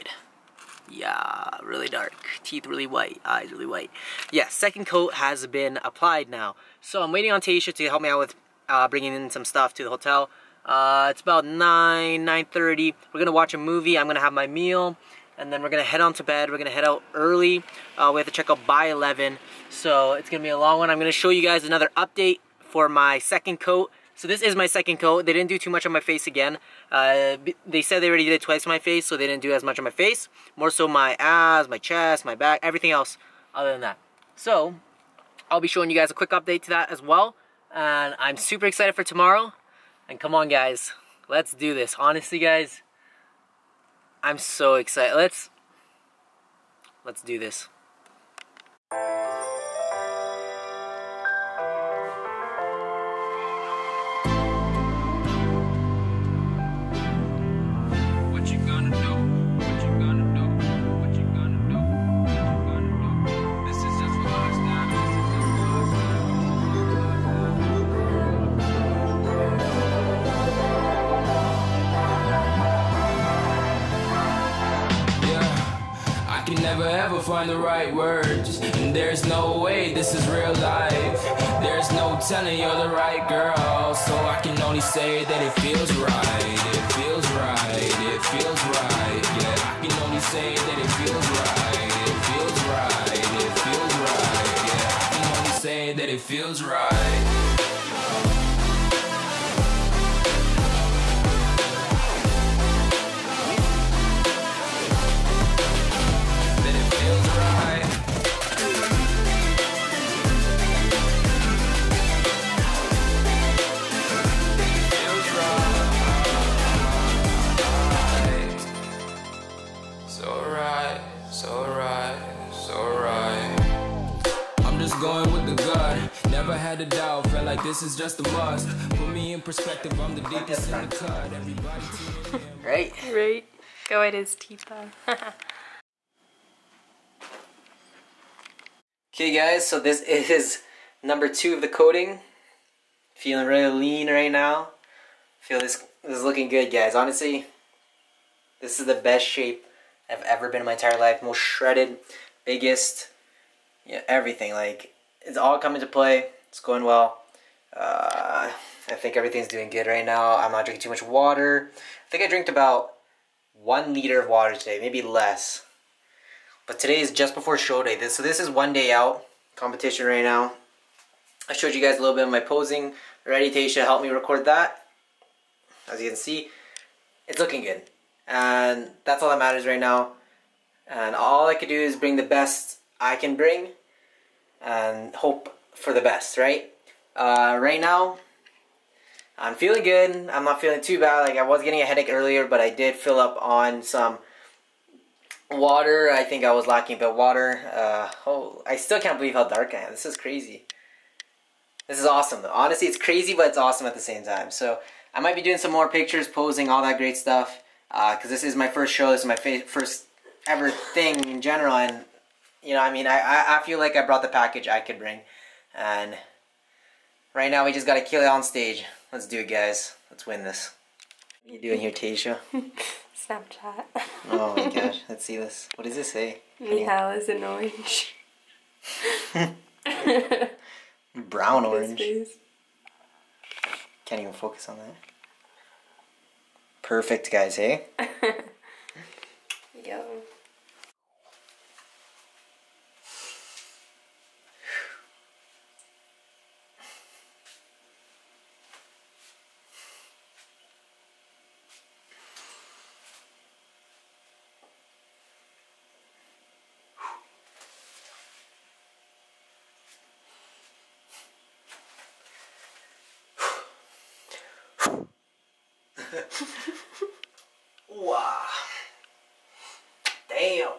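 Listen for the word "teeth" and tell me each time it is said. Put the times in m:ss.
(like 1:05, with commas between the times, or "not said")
0:02, 2:14.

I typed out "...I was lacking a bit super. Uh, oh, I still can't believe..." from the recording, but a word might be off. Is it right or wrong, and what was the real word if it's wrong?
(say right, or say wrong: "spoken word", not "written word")
wrong: "water", not "super".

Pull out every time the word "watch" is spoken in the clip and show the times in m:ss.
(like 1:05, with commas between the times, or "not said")
0:13.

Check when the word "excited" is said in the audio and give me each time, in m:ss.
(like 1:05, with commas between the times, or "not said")
0:38, 0:44.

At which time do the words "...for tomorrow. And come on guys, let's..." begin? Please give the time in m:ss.
0:38.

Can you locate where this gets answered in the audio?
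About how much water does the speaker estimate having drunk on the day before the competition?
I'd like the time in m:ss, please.
2:43.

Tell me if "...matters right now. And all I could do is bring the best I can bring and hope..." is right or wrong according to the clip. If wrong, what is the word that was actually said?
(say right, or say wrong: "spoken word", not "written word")
right.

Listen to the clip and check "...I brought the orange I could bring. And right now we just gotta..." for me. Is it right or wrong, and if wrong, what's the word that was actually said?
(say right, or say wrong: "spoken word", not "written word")
wrong: "package", not "orange".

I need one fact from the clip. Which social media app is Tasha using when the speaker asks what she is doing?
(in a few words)
Snapchat.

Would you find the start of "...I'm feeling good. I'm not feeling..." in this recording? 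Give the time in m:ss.
3:09.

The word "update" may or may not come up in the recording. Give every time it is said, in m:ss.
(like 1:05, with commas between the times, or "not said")
0:21, 0:36.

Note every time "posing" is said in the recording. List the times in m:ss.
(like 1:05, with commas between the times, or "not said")
2:52, 3:26.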